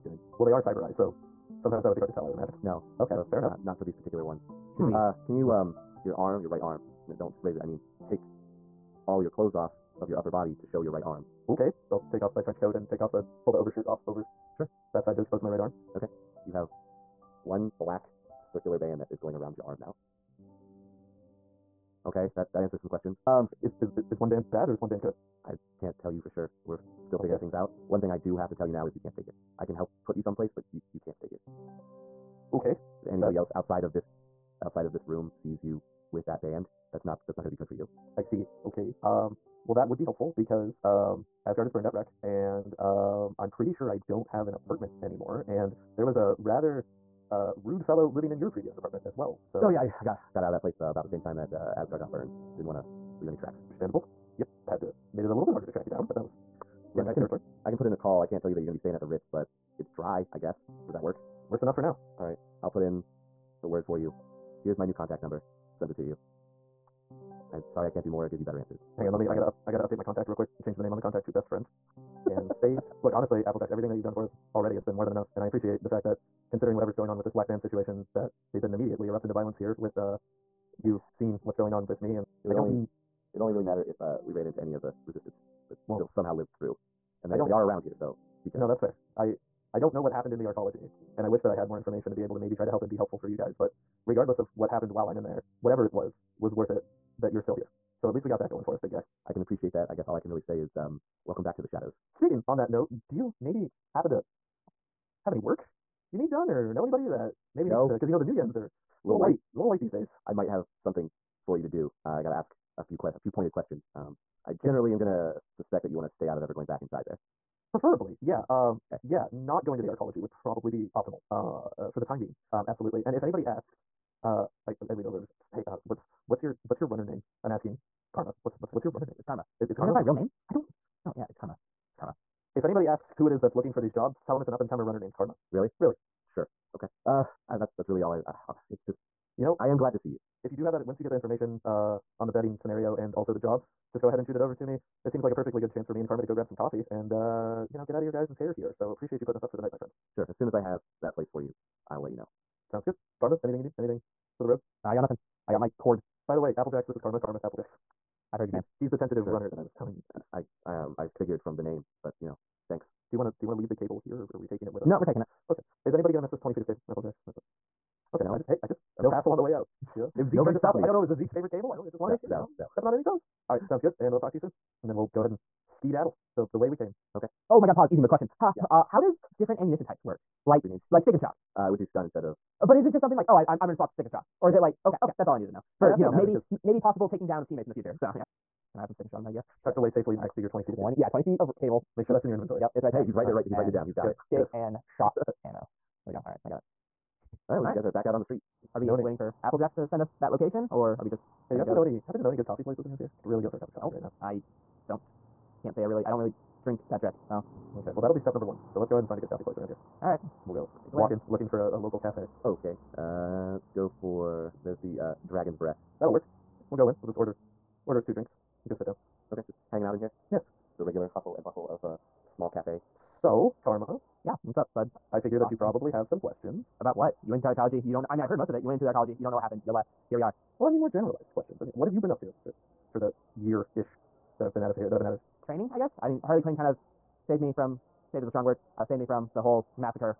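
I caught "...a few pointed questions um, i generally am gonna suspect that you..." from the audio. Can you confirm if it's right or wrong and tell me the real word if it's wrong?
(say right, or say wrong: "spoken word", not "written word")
right.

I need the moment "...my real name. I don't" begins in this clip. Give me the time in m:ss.
2:09.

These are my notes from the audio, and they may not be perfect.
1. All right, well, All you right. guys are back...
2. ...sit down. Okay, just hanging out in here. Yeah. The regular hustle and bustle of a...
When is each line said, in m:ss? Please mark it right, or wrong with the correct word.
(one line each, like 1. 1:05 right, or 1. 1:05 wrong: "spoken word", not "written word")
1. 3:17 right
2. 3:38 right.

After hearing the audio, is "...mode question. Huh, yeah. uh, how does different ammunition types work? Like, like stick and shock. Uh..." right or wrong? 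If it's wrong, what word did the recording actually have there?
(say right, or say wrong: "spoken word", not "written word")
right.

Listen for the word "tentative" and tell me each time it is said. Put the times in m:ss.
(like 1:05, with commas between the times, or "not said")
2:38.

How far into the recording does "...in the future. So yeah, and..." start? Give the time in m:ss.
3:07.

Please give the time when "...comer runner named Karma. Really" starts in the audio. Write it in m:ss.
2:14.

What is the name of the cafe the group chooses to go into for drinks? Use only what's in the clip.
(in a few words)
Dragon's Breath.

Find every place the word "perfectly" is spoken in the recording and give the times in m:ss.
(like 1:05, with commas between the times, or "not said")
2:25.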